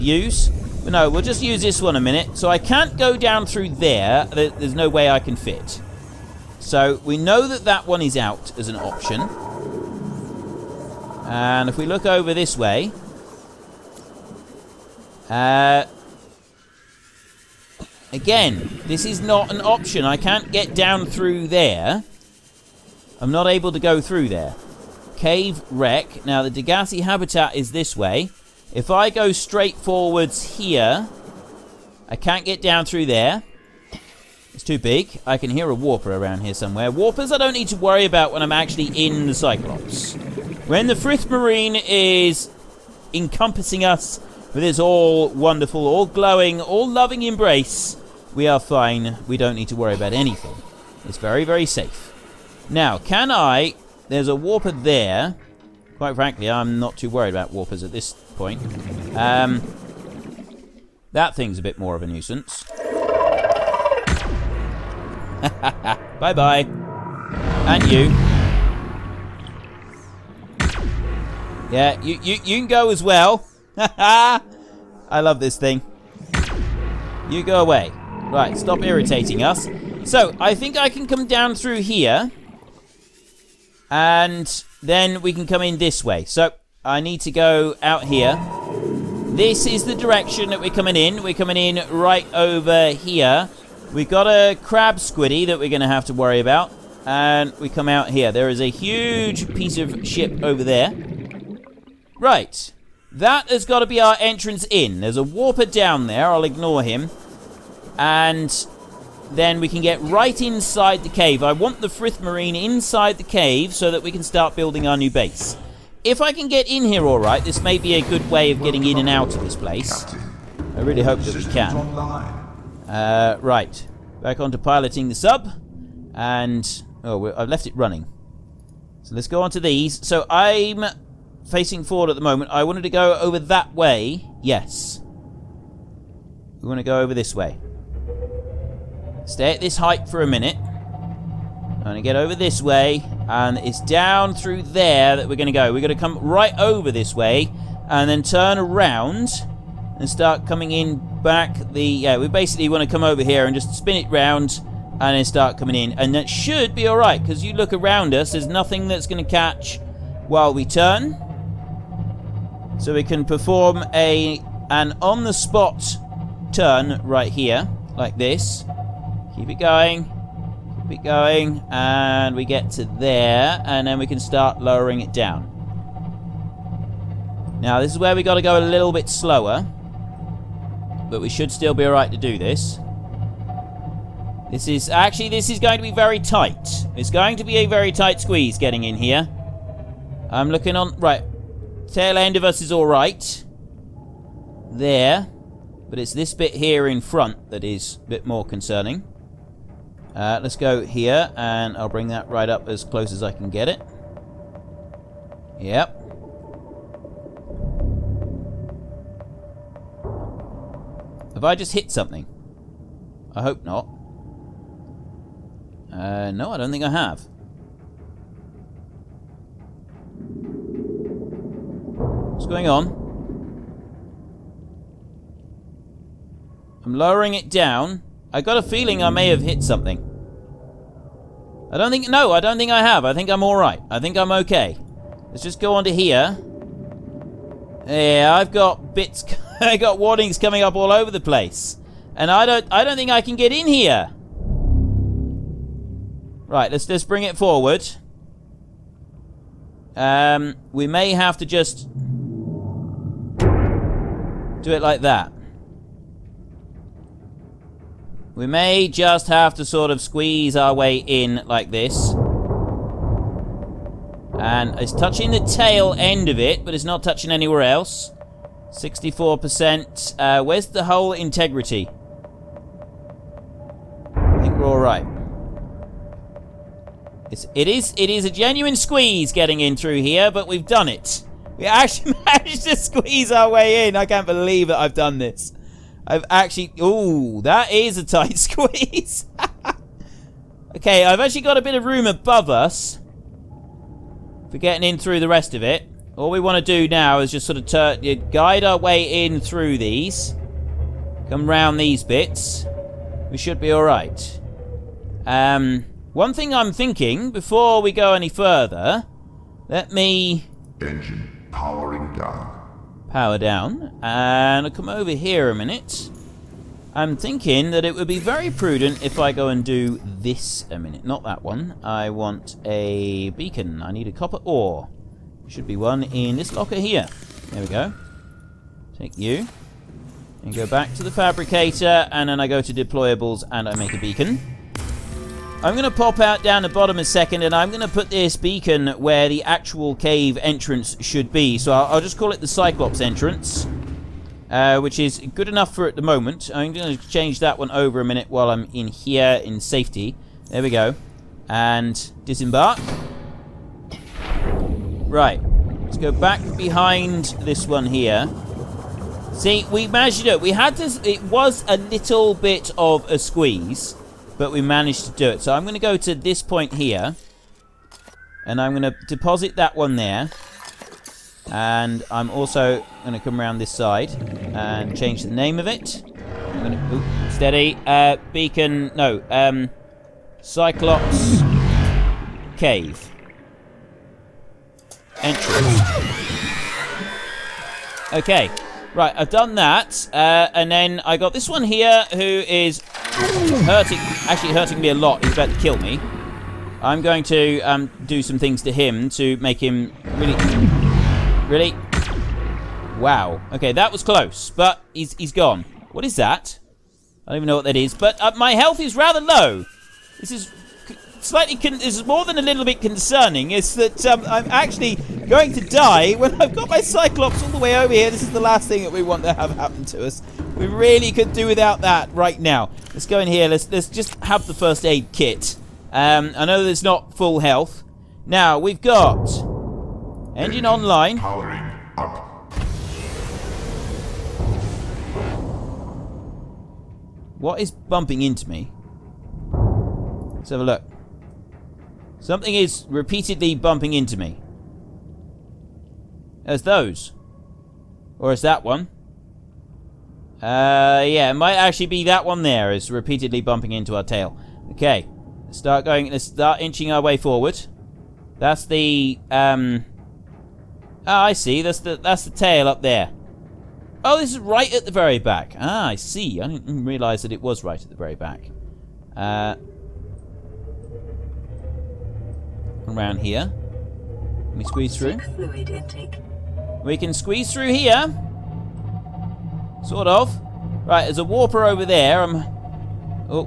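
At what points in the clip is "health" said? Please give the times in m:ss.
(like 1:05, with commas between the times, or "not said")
6:48, 7:07.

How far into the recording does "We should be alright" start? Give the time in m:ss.
5:03.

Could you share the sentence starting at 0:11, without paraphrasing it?
And if we look over this way, uh, again, this is not an option.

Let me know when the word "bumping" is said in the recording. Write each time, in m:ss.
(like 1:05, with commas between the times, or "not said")
7:17, 7:23, 7:33.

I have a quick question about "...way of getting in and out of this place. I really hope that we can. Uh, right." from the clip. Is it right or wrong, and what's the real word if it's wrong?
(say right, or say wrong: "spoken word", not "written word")
right.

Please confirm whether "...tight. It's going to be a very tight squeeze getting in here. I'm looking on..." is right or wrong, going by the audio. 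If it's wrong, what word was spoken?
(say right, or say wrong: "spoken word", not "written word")
right.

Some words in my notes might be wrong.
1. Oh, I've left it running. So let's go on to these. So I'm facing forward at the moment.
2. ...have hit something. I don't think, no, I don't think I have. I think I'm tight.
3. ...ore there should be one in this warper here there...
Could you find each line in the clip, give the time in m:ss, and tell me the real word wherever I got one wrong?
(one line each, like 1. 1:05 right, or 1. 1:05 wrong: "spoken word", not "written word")
1. 2:07 right
2. 3:49 wrong: "alright", not "tight"
3. 5:24 wrong: "locker", not "warper".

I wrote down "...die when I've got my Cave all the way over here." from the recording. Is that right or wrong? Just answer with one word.
wrong.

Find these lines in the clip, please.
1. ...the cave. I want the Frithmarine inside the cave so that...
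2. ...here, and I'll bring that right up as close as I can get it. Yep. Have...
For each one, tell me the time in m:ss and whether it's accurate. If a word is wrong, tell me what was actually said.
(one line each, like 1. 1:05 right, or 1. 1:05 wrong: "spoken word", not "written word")
1. 1:51 right
2. 3:20 right.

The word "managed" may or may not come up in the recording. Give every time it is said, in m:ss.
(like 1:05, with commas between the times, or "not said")
4:42, 6:04.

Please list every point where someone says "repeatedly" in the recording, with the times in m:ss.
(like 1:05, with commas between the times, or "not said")
7:22, 7:32.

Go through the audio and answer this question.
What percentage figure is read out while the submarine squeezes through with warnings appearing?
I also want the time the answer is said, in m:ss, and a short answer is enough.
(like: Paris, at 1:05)
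64%, at 4:28.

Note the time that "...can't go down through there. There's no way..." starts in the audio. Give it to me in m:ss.
0:02.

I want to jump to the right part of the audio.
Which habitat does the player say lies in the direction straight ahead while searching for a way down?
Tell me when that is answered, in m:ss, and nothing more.
0:26.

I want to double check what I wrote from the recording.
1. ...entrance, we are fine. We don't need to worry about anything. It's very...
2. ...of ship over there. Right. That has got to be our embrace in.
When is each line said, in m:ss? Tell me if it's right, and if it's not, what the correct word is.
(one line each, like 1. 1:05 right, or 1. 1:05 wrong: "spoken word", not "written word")
1. 0:47 wrong: "embrace", not "entrance"
2. 1:39 wrong: "entrance", not "embrace".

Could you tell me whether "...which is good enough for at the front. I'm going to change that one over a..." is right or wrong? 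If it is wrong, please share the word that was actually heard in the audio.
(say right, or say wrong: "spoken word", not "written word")
wrong: "moment", not "front".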